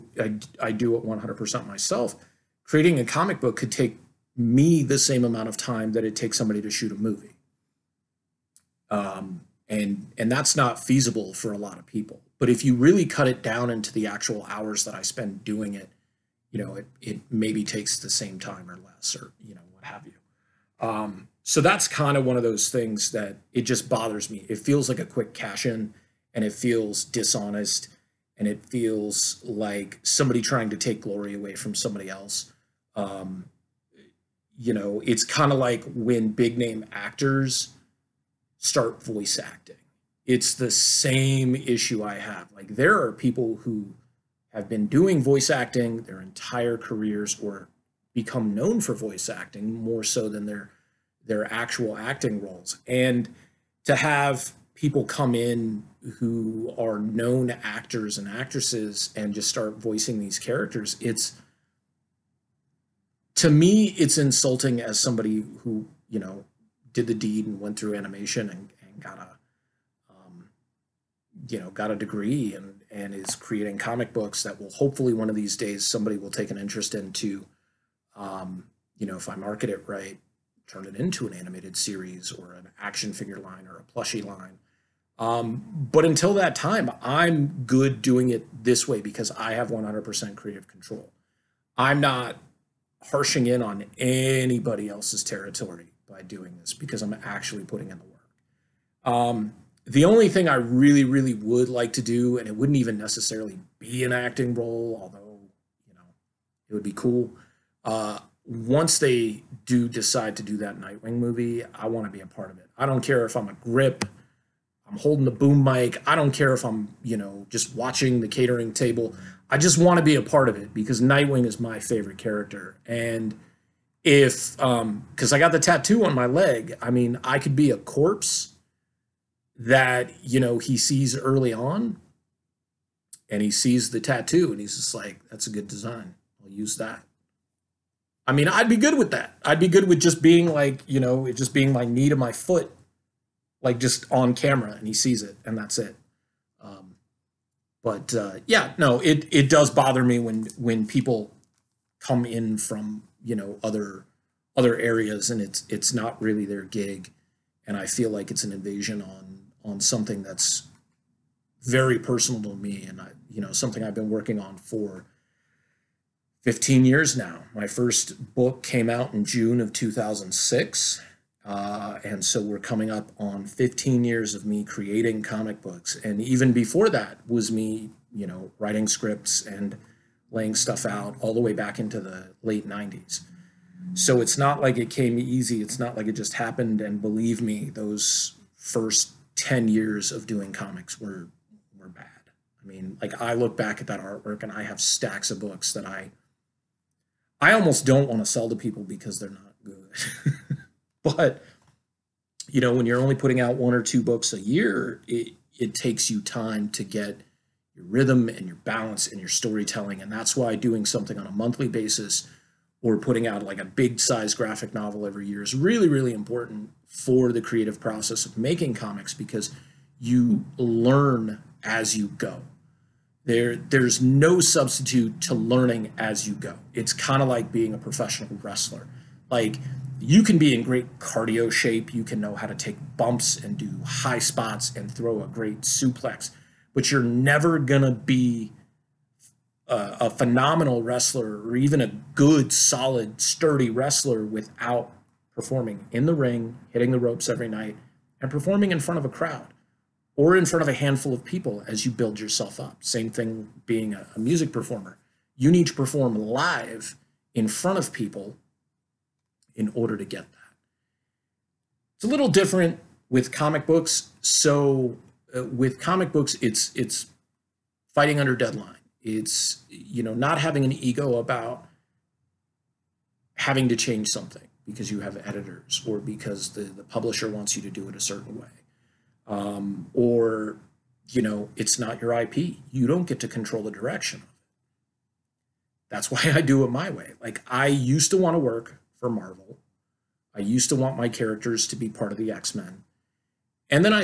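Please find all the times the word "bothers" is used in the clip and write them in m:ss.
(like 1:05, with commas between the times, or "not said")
0:23, 2:29.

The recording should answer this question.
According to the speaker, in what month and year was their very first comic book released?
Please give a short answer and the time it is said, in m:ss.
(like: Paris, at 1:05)
June 2006, at 2:49.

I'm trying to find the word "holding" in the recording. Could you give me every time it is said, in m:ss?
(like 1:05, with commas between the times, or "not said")
1:54.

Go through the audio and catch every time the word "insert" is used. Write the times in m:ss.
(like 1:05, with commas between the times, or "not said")
not said.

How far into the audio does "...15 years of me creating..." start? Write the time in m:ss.
2:53.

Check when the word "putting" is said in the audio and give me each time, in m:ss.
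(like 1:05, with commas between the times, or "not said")
1:37, 3:23, 3:32.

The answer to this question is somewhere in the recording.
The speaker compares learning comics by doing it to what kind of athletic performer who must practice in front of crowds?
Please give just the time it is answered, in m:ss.
3:47.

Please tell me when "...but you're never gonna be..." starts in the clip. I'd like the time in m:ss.
3:56.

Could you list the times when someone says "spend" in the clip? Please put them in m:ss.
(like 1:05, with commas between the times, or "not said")
0:15.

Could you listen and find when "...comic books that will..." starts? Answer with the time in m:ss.
1:13.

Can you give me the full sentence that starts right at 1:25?
Um, but until that time, I'm good doing it this way because I have 100% creative control.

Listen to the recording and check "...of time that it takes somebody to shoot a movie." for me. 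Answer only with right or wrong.
right.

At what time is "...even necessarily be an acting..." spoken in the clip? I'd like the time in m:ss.
1:42.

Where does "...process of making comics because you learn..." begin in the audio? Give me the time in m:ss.
3:37.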